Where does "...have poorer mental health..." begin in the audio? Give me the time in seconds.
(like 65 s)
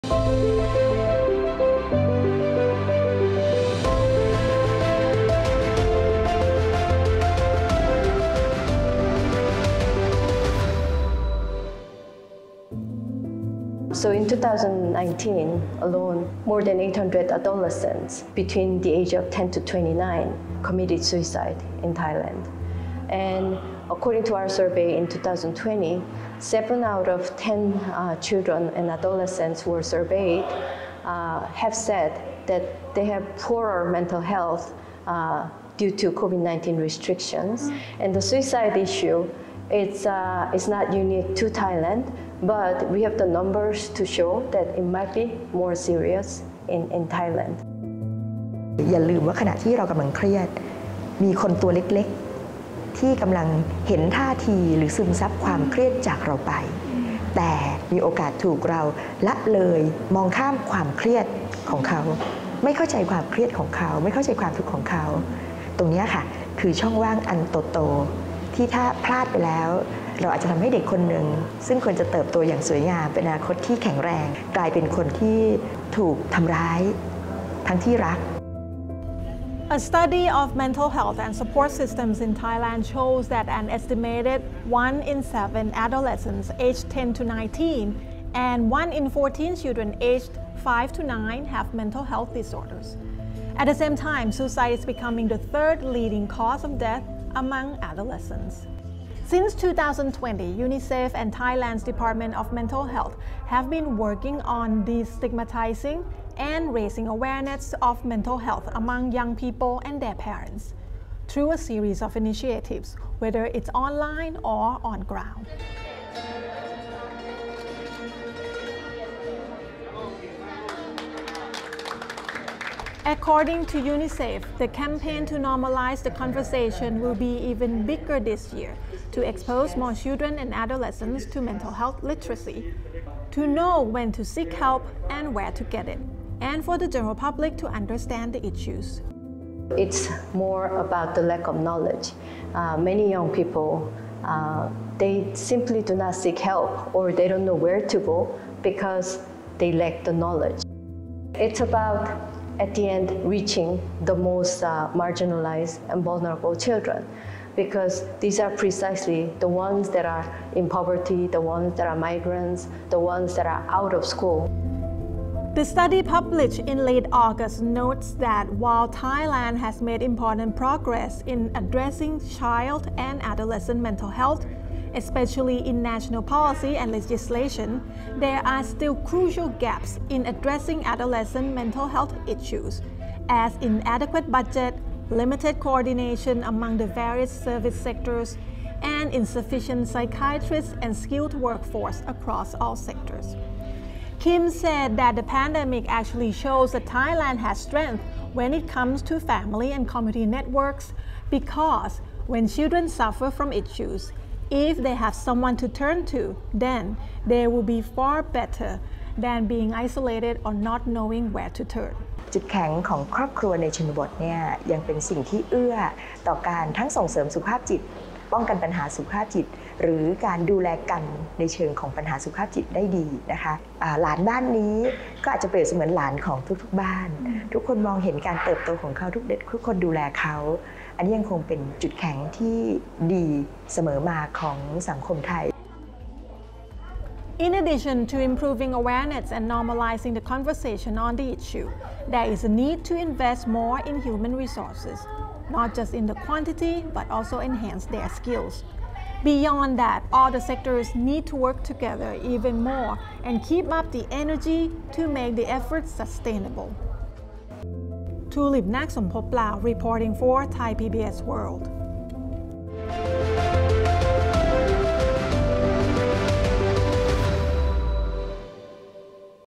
33 s.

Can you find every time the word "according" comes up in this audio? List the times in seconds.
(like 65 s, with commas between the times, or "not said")
23 s, 123 s.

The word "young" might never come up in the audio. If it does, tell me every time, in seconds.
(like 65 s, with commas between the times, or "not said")
109 s, 143 s.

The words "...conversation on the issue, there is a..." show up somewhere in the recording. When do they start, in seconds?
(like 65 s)
240 s.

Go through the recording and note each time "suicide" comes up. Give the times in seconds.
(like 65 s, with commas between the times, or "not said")
21 s, 38 s, 94 s.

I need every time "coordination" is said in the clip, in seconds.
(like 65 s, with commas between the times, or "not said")
185 s.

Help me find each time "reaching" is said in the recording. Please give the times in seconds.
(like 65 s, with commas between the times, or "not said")
153 s.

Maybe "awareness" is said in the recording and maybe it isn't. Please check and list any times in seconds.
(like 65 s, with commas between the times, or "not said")
107 s, 238 s.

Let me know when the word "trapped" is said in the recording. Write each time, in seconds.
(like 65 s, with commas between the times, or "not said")
not said.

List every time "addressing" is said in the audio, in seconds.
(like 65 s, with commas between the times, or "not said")
171 s, 180 s.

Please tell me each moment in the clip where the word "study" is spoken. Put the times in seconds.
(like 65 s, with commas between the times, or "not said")
79 s, 165 s.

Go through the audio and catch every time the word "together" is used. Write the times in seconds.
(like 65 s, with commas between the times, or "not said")
251 s.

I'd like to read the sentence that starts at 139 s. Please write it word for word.
It's more about the lack of knowledge.